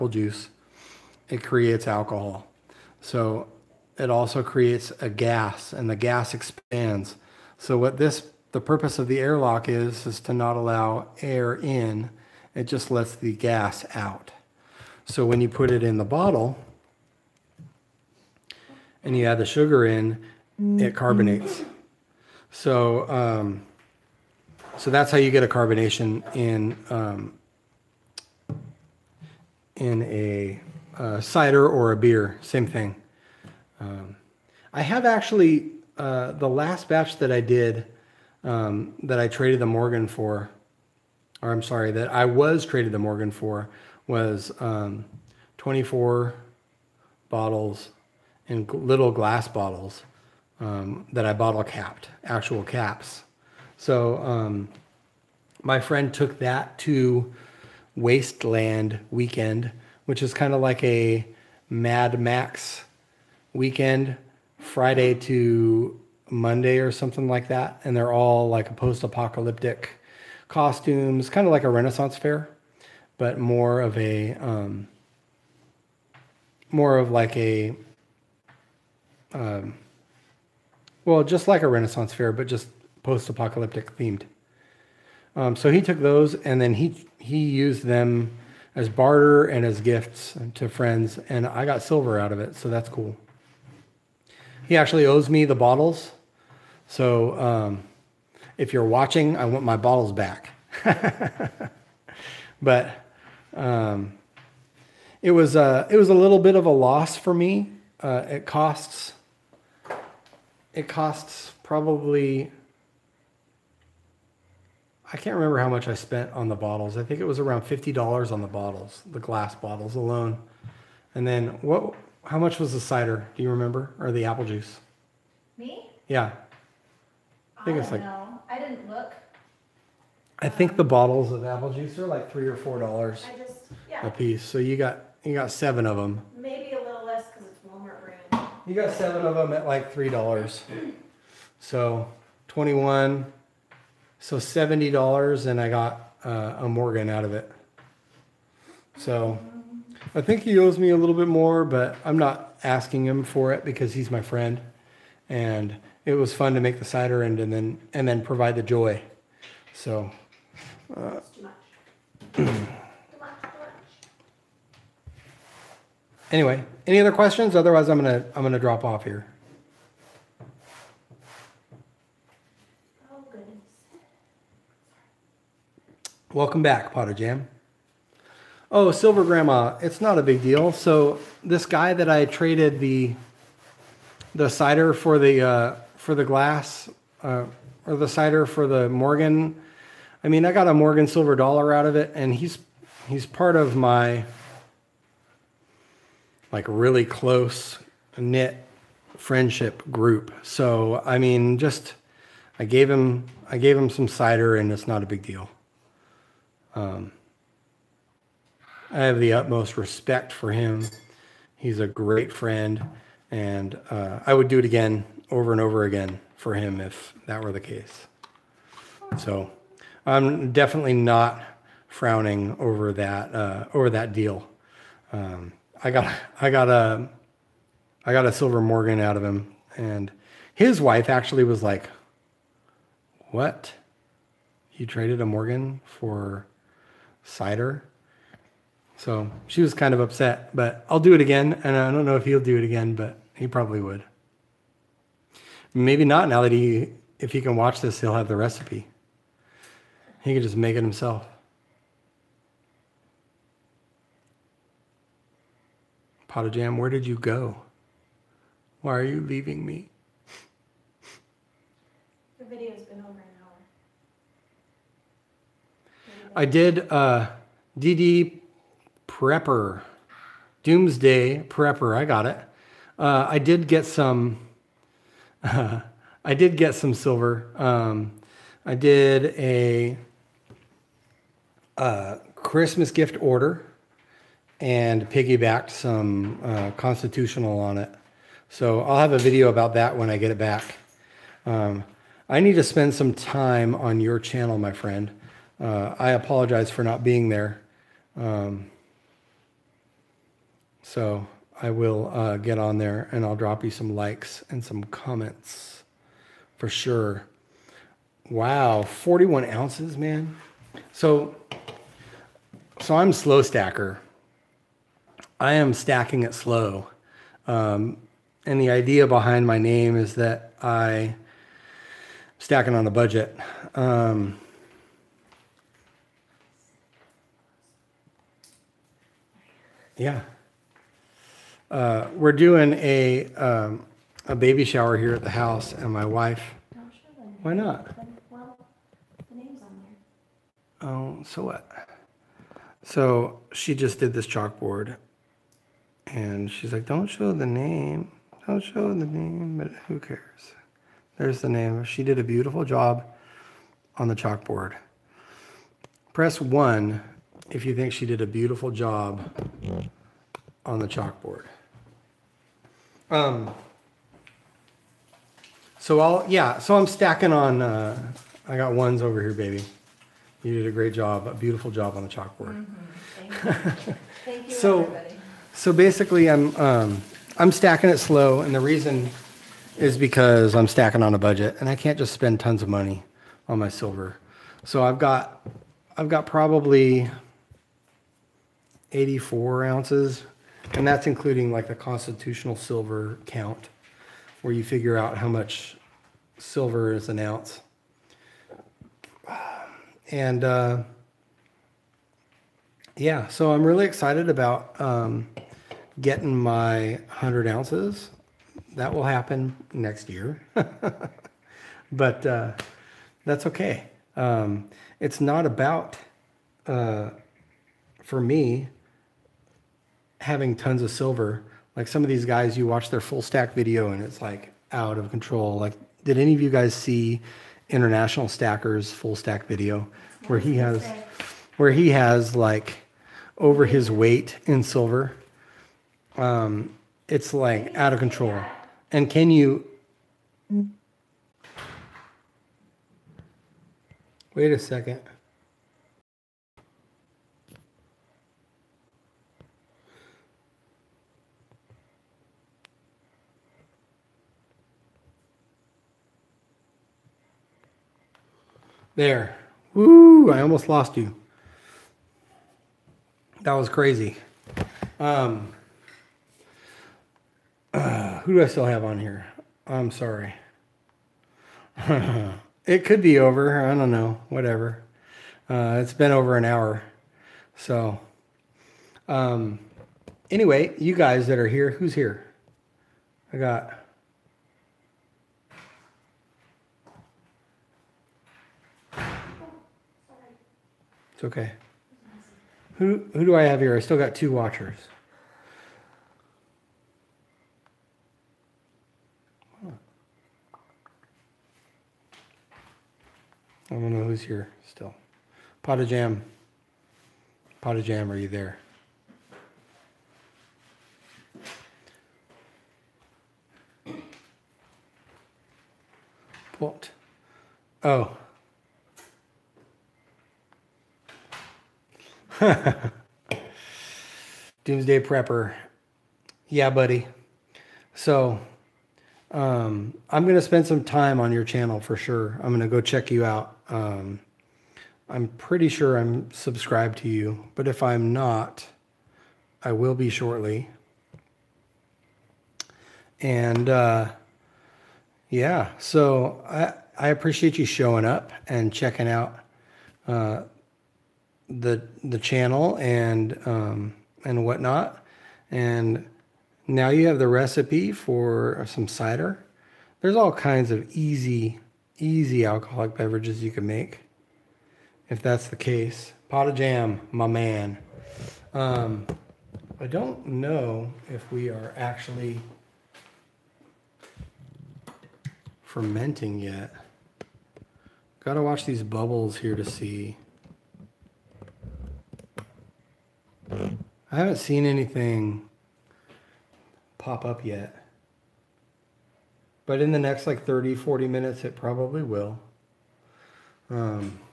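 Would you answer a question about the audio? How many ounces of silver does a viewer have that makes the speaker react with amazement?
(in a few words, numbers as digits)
41 ounces.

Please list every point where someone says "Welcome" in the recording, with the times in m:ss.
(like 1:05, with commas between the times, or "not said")
2:56.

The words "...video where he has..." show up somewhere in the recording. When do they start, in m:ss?
7:09.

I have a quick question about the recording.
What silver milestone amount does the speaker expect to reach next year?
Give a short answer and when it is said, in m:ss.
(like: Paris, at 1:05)
100 ounces, at 6:47.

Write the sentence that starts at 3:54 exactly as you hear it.
You traded a Morgan for cider?" So she was kind of upset, but I'll do it again.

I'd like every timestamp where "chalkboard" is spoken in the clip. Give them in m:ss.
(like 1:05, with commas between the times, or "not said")
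5:44, 5:54, 6:00, 6:12.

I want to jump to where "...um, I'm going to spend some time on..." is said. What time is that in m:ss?
8:49.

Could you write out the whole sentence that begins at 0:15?
So when you put it in the bottle and you add the sugar in, it carbonates.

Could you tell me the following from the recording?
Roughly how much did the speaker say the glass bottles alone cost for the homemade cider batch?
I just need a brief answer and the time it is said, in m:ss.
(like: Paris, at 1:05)
$50, at 1:57.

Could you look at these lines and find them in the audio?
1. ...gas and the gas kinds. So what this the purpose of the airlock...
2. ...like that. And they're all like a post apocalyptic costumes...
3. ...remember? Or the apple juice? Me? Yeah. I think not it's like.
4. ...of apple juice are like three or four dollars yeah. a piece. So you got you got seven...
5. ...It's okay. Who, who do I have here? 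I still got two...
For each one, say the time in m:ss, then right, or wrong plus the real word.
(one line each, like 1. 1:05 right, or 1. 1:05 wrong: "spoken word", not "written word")
1. 0:05 wrong: "expands", not "kinds"
2. 1:07 right
3. 2:03 right
4. 2:11 right
5. 8:11 right.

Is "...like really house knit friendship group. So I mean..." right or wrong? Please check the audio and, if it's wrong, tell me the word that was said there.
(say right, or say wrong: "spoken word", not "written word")
wrong: "close", not "house".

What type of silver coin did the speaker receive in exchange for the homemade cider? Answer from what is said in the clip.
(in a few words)
Morgan silver dollar.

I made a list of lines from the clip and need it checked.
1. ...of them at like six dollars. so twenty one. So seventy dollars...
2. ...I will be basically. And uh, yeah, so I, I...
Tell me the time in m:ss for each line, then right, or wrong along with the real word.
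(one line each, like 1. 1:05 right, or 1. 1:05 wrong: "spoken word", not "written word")
1. 2:19 wrong: "three", not "six"
2. 8:59 wrong: "shortly", not "basically".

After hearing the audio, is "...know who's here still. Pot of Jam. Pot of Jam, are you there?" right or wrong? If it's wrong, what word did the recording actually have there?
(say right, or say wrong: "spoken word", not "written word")
right.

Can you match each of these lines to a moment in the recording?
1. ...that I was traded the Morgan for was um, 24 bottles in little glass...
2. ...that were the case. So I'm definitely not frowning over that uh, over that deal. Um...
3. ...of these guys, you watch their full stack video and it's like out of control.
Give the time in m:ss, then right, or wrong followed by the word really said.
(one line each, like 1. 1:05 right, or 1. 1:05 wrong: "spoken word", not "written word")
1. 0:41 right
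2. 3:37 right
3. 7:02 right.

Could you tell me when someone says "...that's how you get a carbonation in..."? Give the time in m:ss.
0:24.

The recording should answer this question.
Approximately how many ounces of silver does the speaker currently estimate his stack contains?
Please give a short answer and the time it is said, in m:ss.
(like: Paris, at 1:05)
84, at 6:28.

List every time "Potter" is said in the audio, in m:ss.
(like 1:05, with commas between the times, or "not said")
2:56.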